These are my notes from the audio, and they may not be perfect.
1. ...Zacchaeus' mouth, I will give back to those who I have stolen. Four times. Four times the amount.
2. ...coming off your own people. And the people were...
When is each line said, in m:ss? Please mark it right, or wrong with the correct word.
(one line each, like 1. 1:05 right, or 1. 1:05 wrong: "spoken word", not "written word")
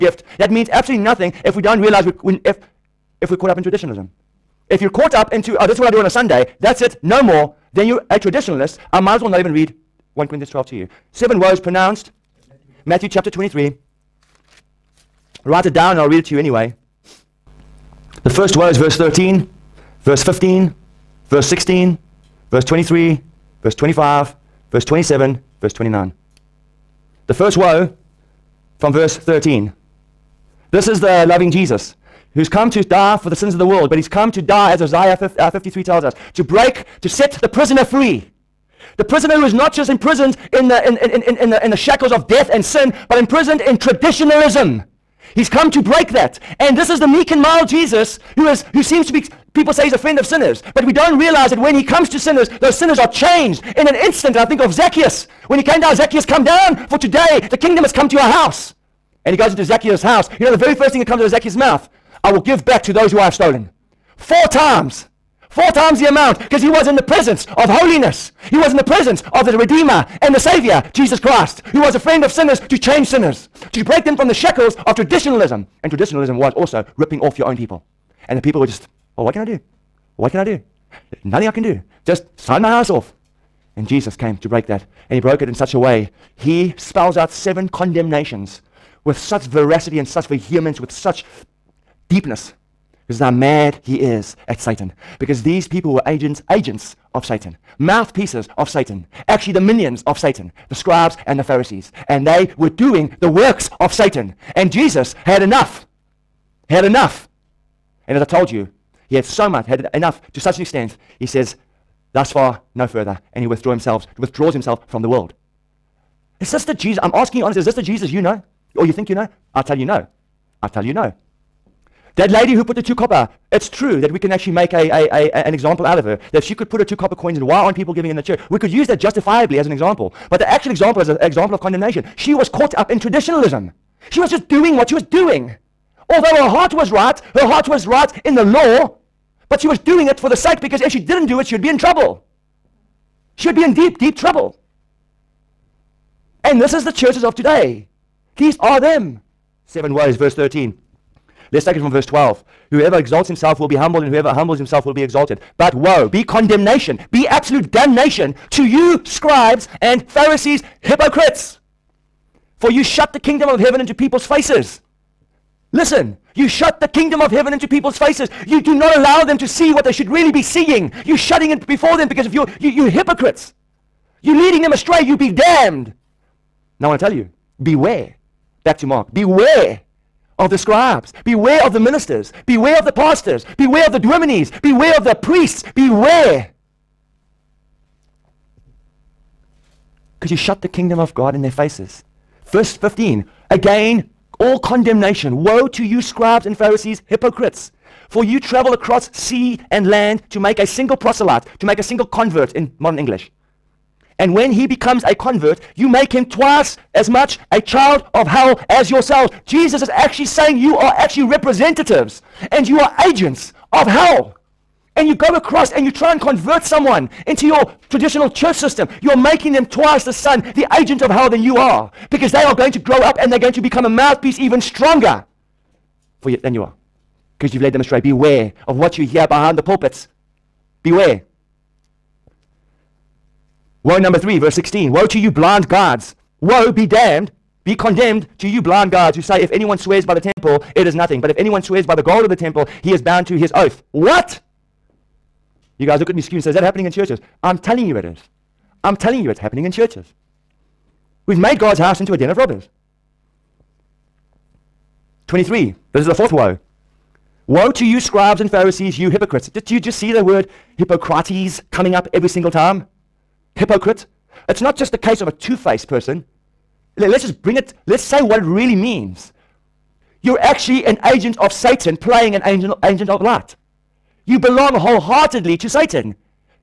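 1. 1:01 right
2. 1:16 wrong: "ripping", not "coming".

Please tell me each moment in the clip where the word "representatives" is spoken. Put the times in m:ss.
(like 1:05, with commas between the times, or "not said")
3:31.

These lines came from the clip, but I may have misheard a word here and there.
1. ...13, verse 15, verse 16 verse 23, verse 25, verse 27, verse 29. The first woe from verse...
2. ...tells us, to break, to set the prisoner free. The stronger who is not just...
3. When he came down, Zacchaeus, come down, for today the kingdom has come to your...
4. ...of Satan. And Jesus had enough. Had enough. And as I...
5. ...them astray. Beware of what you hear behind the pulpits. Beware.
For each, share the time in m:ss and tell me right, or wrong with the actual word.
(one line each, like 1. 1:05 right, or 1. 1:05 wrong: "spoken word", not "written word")
1. 0:18 right
2. 0:35 wrong: "prisoner", not "stronger"
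3. 0:55 right
4. 1:43 right
5. 3:47 right.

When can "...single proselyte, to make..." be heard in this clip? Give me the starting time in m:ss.
3:20.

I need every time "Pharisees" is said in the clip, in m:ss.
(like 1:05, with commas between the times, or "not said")
1:41, 2:40, 3:16, 4:18.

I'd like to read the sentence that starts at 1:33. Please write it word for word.
Because how mad he is at Satan.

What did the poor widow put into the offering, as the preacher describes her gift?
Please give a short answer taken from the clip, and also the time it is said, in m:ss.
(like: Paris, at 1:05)
2 copper coins, at 2:06.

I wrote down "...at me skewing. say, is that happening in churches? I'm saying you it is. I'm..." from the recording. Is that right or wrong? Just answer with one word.
wrong.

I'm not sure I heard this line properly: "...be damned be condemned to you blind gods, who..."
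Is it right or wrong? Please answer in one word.
right.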